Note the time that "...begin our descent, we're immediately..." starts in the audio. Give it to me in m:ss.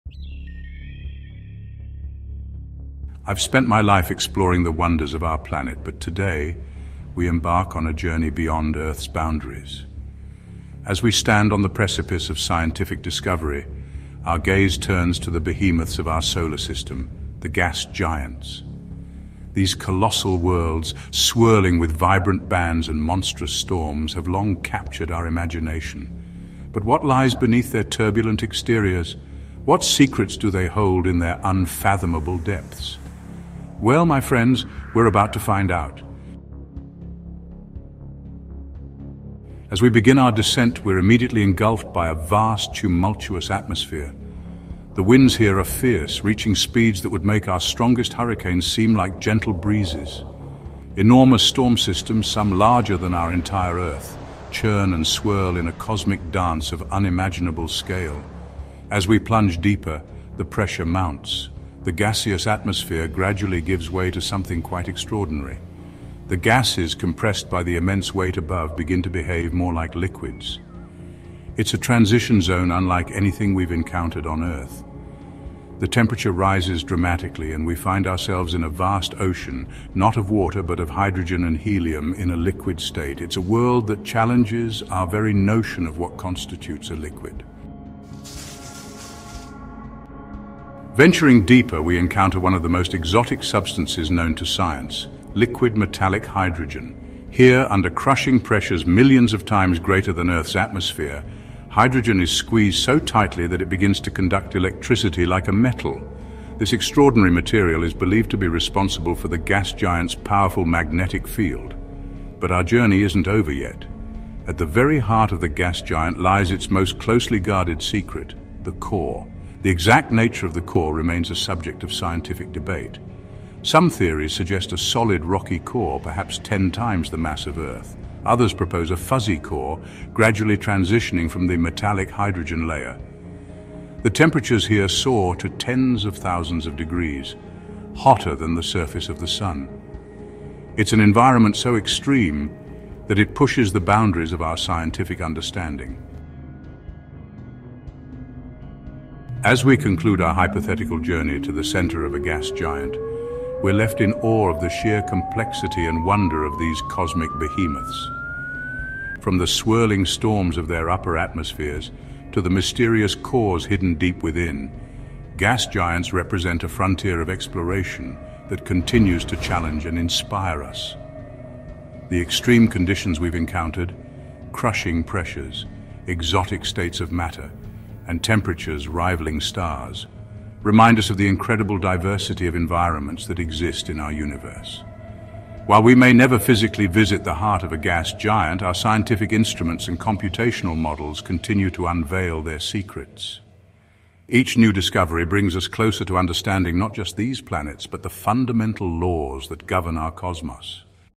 0:39.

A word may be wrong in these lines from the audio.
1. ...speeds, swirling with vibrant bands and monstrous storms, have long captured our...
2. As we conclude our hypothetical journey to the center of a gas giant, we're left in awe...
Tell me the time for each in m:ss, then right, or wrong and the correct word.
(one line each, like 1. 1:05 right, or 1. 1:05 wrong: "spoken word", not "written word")
1. 0:20 wrong: "worlds", not "speeds"
2. 2:29 right.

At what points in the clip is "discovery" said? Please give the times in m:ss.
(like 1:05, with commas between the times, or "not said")
0:13, 3:14.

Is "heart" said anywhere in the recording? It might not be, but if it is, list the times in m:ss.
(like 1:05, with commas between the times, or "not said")
1:54, 3:07.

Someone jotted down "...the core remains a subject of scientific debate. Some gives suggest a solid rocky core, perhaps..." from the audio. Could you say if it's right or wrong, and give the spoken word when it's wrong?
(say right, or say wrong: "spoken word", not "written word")
wrong: "theories", not "gives".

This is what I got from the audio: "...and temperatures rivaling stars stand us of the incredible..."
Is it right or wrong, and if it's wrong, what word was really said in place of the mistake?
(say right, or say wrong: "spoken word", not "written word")
wrong: "remind", not "stand".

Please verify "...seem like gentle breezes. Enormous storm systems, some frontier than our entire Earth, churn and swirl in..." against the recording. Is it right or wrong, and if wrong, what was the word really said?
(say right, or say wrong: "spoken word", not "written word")
wrong: "larger", not "frontier".